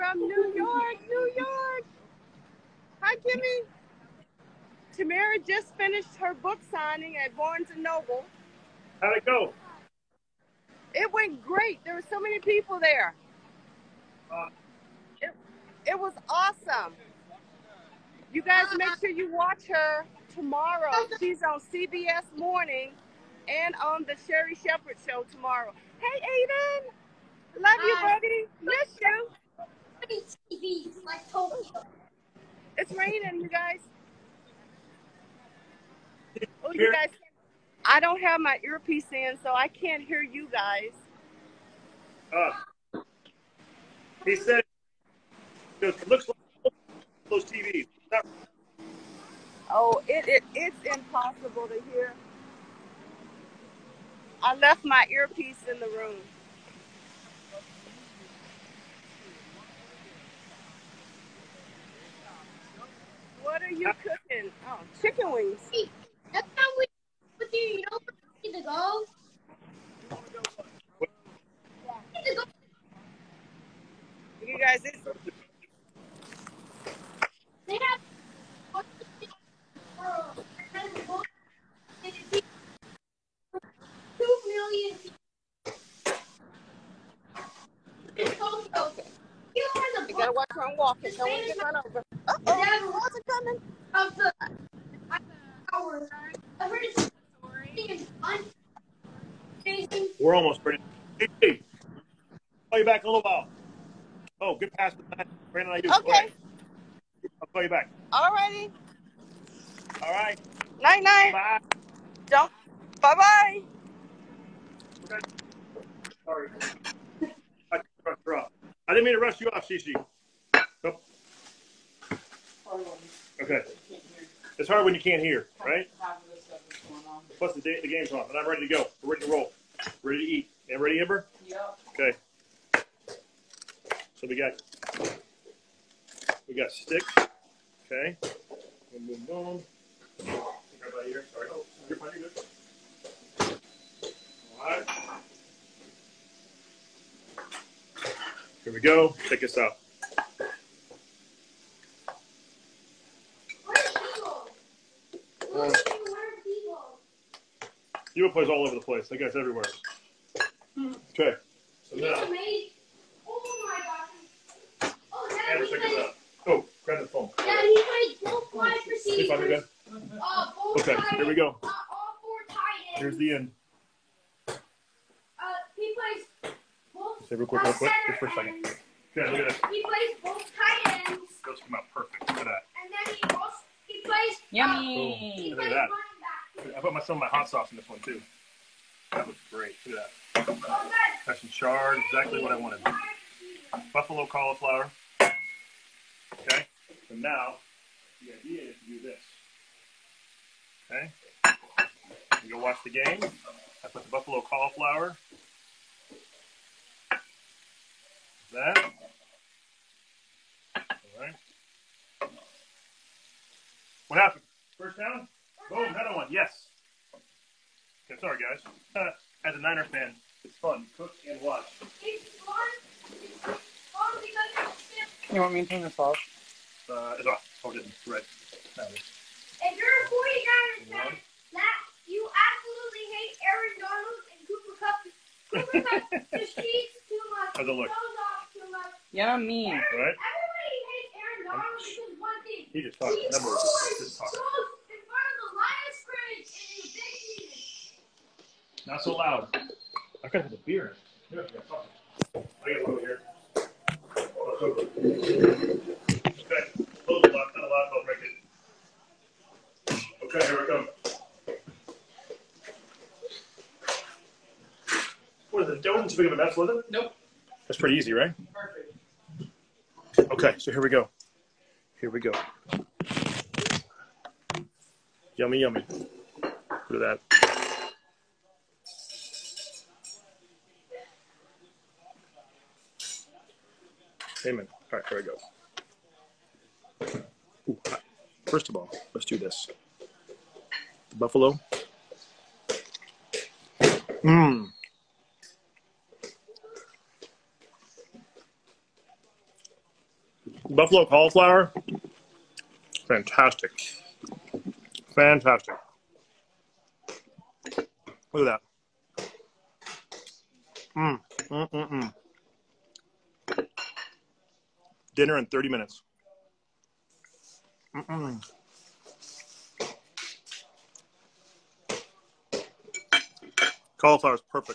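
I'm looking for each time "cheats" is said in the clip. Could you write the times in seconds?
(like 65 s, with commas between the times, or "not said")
236 s.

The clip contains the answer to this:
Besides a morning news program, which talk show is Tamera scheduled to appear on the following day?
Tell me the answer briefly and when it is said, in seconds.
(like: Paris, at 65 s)
Sherri Shepherd Show, at 24 s.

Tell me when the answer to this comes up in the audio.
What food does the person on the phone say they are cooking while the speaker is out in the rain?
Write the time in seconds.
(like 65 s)
65 s.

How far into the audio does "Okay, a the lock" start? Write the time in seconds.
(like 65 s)
254 s.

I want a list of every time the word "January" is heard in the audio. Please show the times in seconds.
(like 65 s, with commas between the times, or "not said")
not said.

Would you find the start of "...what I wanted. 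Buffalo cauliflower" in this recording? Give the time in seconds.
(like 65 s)
192 s.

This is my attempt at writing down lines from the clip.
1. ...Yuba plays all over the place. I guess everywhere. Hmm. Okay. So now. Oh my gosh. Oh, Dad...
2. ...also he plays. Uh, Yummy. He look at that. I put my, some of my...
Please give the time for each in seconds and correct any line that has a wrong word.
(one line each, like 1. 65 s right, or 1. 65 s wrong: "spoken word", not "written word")
1. 158 s right
2. 183 s right.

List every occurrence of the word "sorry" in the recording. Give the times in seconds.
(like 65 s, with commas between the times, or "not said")
116 s, 140 s, 218 s.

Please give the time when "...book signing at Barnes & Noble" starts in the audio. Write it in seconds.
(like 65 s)
6 s.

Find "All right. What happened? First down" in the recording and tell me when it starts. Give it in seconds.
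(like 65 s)
210 s.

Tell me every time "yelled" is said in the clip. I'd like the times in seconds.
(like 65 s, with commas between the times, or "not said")
not said.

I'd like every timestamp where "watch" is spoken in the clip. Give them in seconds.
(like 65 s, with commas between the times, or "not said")
19 s, 90 s, 202 s, 221 s.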